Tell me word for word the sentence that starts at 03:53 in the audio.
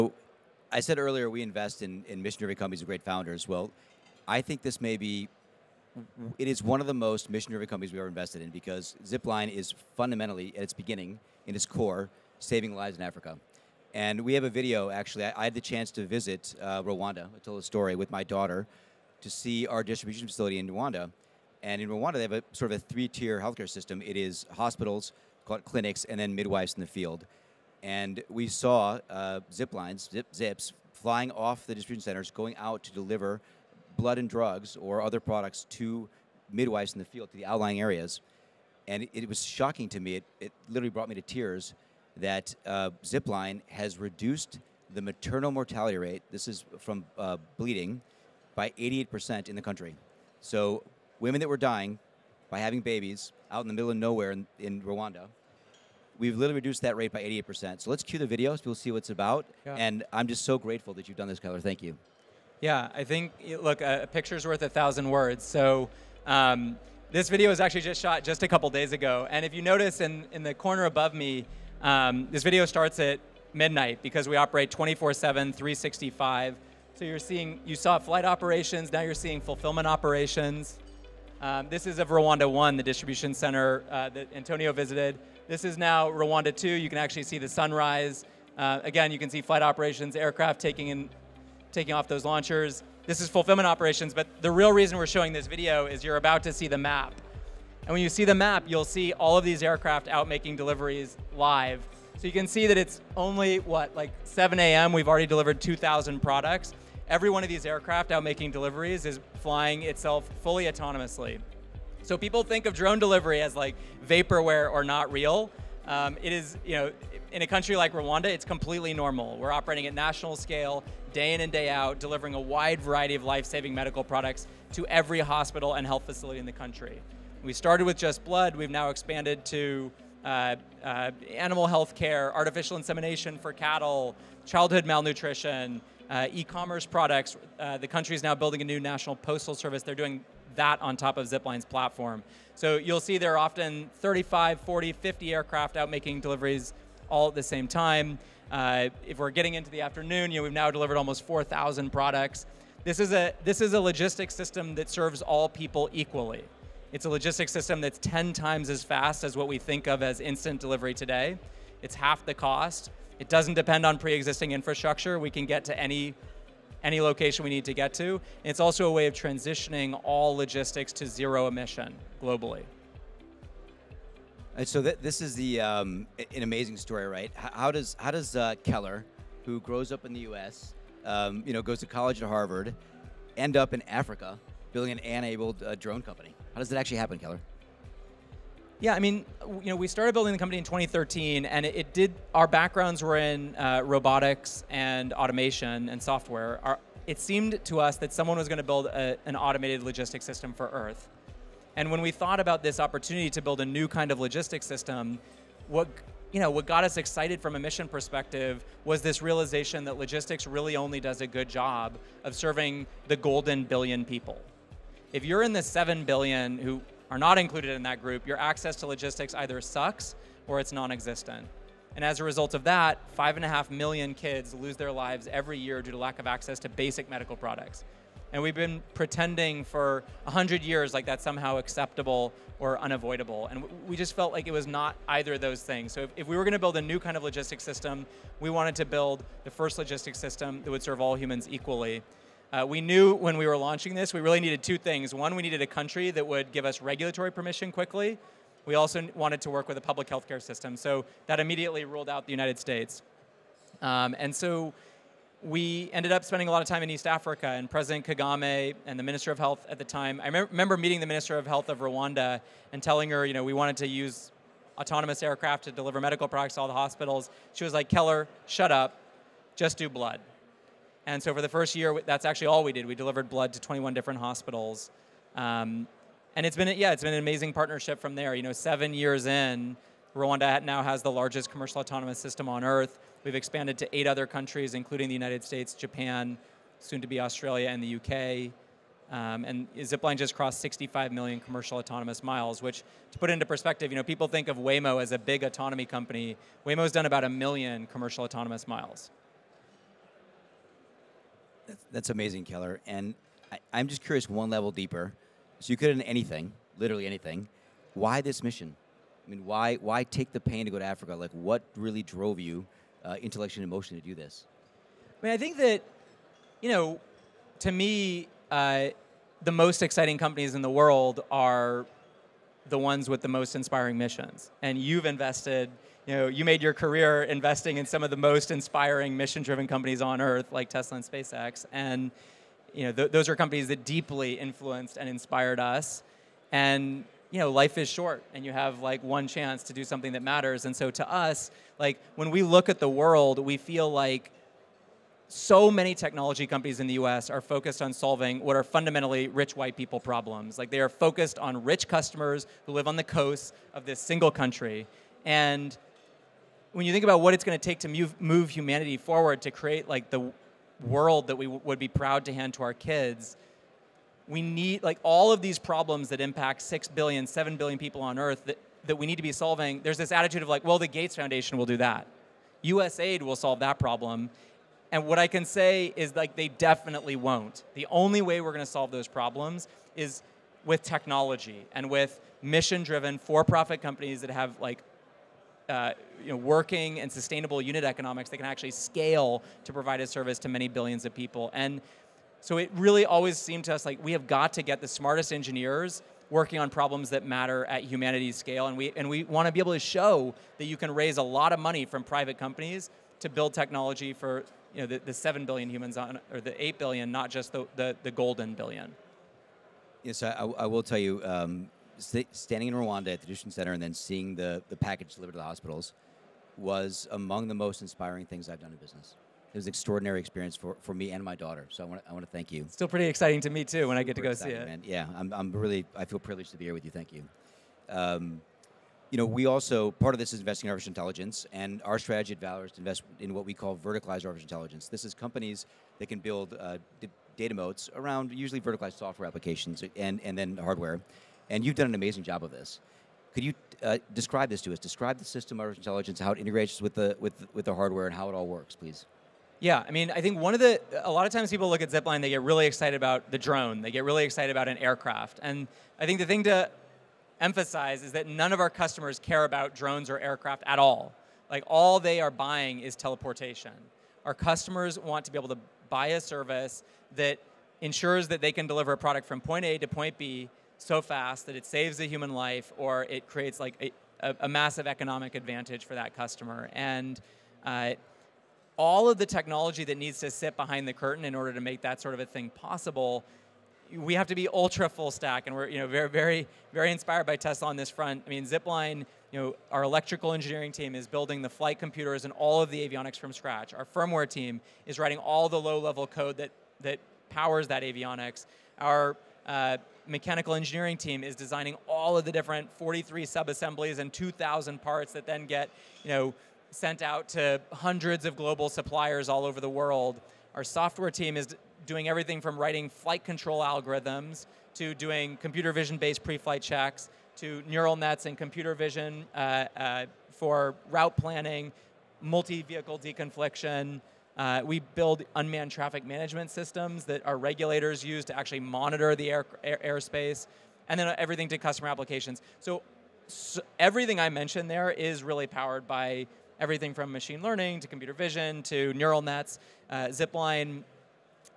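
And we just felt like it was not either of those things.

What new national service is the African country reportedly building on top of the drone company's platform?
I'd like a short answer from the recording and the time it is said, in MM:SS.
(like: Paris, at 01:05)
postal service, at 02:18.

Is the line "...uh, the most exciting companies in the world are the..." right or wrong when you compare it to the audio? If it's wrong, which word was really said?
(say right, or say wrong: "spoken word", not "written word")
right.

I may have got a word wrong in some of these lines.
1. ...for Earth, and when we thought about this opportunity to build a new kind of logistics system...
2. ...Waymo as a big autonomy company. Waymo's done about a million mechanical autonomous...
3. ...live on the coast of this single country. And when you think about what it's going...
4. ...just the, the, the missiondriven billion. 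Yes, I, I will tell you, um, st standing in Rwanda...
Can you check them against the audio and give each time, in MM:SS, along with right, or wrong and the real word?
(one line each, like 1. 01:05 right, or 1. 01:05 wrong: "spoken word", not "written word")
1. 03:20 right
2. 04:54 wrong: "commercial", not "mechanical"
3. 05:52 right
4. 06:47 wrong: "golden", not "missiondriven".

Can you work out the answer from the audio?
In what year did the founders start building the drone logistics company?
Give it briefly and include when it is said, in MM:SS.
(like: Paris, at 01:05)
2013, at 03:10.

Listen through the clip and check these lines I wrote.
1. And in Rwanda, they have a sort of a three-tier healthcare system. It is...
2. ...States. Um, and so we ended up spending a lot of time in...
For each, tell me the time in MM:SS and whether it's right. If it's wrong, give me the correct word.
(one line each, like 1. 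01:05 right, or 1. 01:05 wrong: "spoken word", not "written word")
1. 00:21 right
2. 04:12 right.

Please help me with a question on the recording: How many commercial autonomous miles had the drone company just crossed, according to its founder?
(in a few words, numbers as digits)
65 million.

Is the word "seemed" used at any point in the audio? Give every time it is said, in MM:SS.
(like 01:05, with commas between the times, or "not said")
03:17, 06:33.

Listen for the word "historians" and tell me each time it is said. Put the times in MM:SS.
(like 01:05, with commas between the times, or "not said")
not said.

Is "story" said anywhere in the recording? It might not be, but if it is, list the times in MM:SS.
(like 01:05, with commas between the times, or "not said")
00:17, 02:56.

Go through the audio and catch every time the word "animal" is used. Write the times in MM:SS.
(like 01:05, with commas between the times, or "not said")
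02:11.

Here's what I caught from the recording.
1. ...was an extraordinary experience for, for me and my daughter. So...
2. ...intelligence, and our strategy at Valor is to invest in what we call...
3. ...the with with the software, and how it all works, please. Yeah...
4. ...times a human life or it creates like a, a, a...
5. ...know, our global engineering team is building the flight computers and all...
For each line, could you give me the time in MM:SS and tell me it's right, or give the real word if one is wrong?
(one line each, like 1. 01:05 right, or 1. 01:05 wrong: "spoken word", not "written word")
1. 06:59 right
2. 07:10 right
3. 07:26 wrong: "hardware", not "software"
4. 07:51 wrong: "saves", not "times"
5. 08:09 wrong: "electrical", not "global".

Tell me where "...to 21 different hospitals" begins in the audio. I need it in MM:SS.
04:33.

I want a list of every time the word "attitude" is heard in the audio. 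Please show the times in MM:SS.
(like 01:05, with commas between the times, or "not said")
06:10.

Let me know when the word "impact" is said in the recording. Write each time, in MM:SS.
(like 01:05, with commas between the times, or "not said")
06:06.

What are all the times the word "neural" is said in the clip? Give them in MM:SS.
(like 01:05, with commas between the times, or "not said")
08:37, 08:58.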